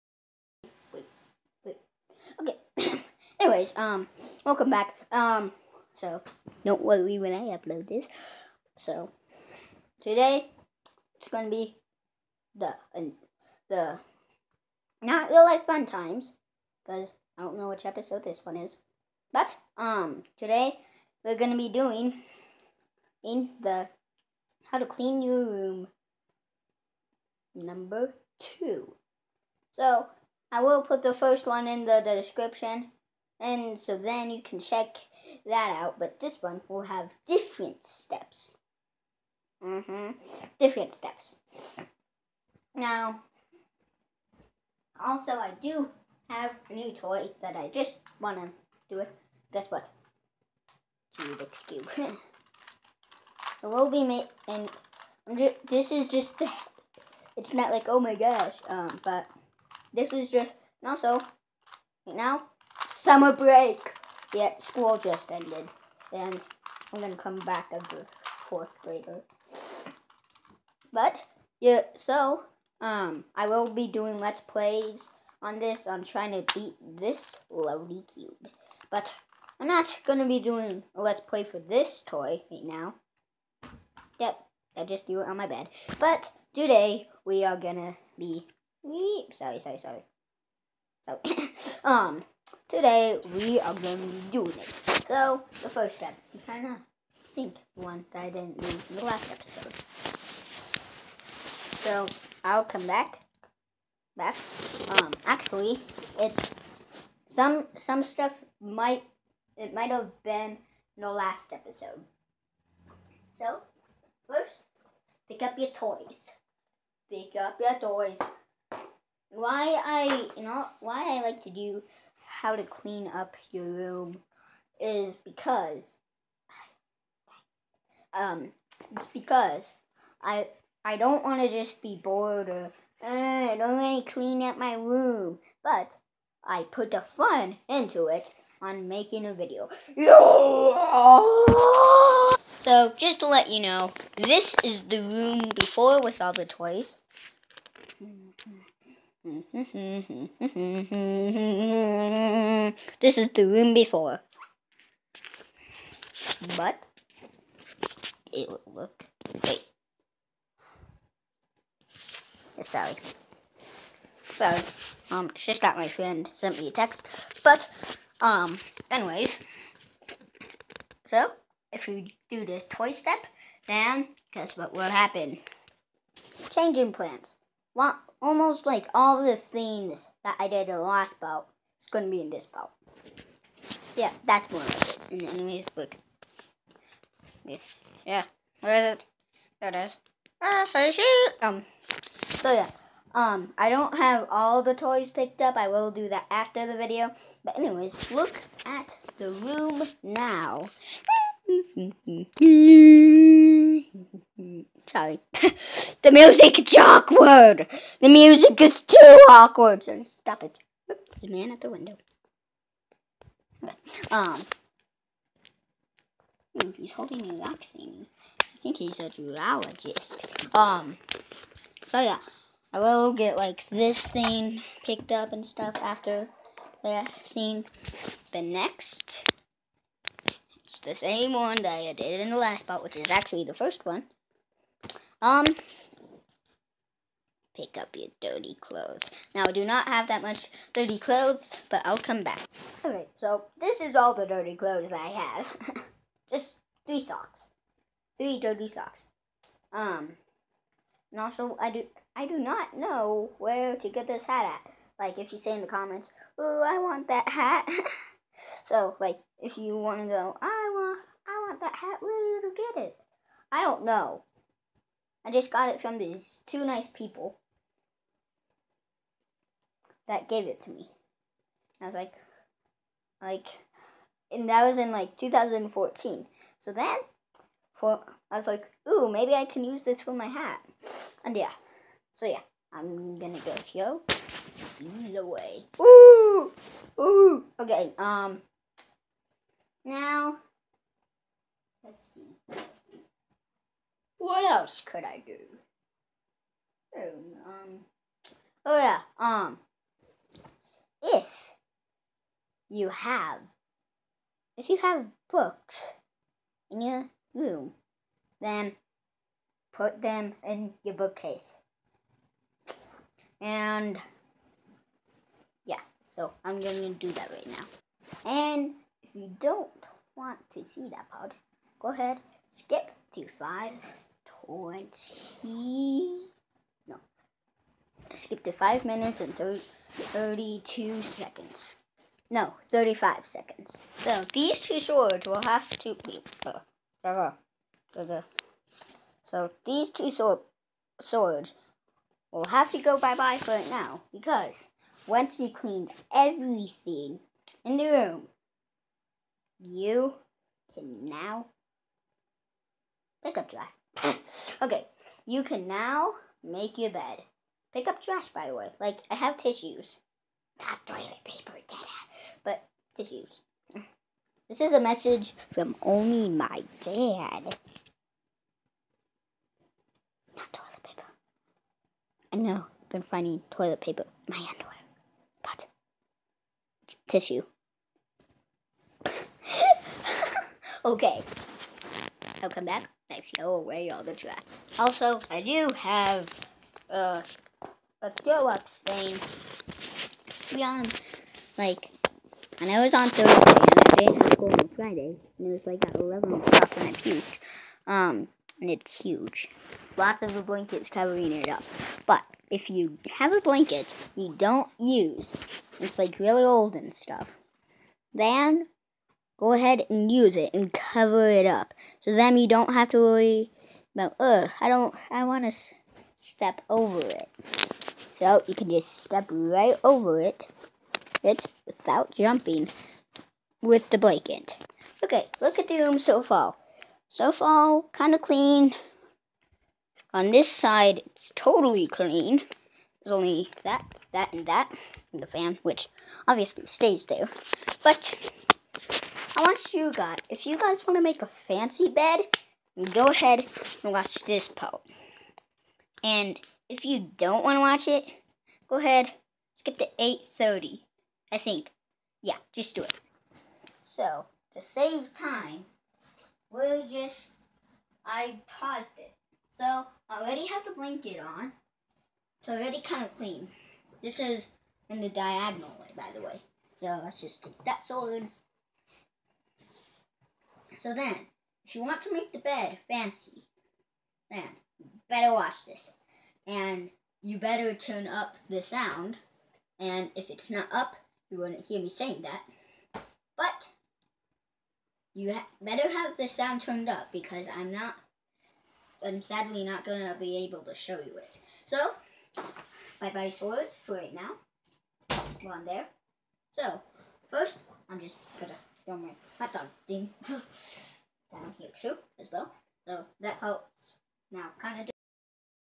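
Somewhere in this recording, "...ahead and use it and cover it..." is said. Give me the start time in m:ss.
6:49.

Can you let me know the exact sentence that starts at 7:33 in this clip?
So, to save time, we'll just, I paused it.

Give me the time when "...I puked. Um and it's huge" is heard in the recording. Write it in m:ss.
6:36.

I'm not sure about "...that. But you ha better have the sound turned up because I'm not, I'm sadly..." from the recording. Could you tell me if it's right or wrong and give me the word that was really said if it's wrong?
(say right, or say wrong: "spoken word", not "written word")
right.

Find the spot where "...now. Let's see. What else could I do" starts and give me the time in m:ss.
4:49.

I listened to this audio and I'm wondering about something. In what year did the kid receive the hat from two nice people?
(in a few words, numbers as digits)
2014.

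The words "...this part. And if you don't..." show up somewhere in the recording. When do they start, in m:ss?
7:24.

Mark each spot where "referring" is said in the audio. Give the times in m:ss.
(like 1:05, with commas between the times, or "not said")
not said.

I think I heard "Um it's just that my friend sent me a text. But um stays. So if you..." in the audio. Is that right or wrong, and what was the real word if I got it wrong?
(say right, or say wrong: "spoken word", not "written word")
wrong: "anyways", not "stays".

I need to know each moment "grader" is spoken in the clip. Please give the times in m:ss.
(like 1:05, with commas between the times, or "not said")
1:08.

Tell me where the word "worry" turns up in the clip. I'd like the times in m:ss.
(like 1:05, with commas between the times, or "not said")
0:06, 6:52.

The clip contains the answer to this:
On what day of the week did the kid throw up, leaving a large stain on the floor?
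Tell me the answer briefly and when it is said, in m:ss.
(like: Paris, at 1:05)
Thursday, at 6:33.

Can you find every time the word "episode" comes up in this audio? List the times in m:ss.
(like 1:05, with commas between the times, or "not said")
0:17, 1:39, 1:51.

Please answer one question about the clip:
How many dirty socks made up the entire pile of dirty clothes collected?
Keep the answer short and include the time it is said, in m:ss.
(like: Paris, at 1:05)
3, at 4:08.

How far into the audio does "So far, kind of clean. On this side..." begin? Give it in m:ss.
7:07.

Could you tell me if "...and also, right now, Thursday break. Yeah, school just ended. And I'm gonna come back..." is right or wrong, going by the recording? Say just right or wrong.
wrong.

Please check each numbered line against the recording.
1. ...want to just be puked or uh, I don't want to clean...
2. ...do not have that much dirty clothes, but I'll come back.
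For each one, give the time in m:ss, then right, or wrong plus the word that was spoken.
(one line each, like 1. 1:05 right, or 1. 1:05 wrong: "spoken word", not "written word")
1. 2:11 wrong: "bored", not "puked"
2. 3:59 right.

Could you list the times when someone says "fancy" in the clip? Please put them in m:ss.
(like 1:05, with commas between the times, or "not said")
7:21, 7:52.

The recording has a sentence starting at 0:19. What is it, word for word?
But um, today we're gonna be doing in the how to clean your room number two.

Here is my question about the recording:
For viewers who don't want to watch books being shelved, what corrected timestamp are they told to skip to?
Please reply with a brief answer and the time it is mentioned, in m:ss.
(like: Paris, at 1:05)
5 minutes 35 seconds, at 5:32.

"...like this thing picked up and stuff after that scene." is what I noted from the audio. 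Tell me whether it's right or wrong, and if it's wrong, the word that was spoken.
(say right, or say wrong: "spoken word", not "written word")
right.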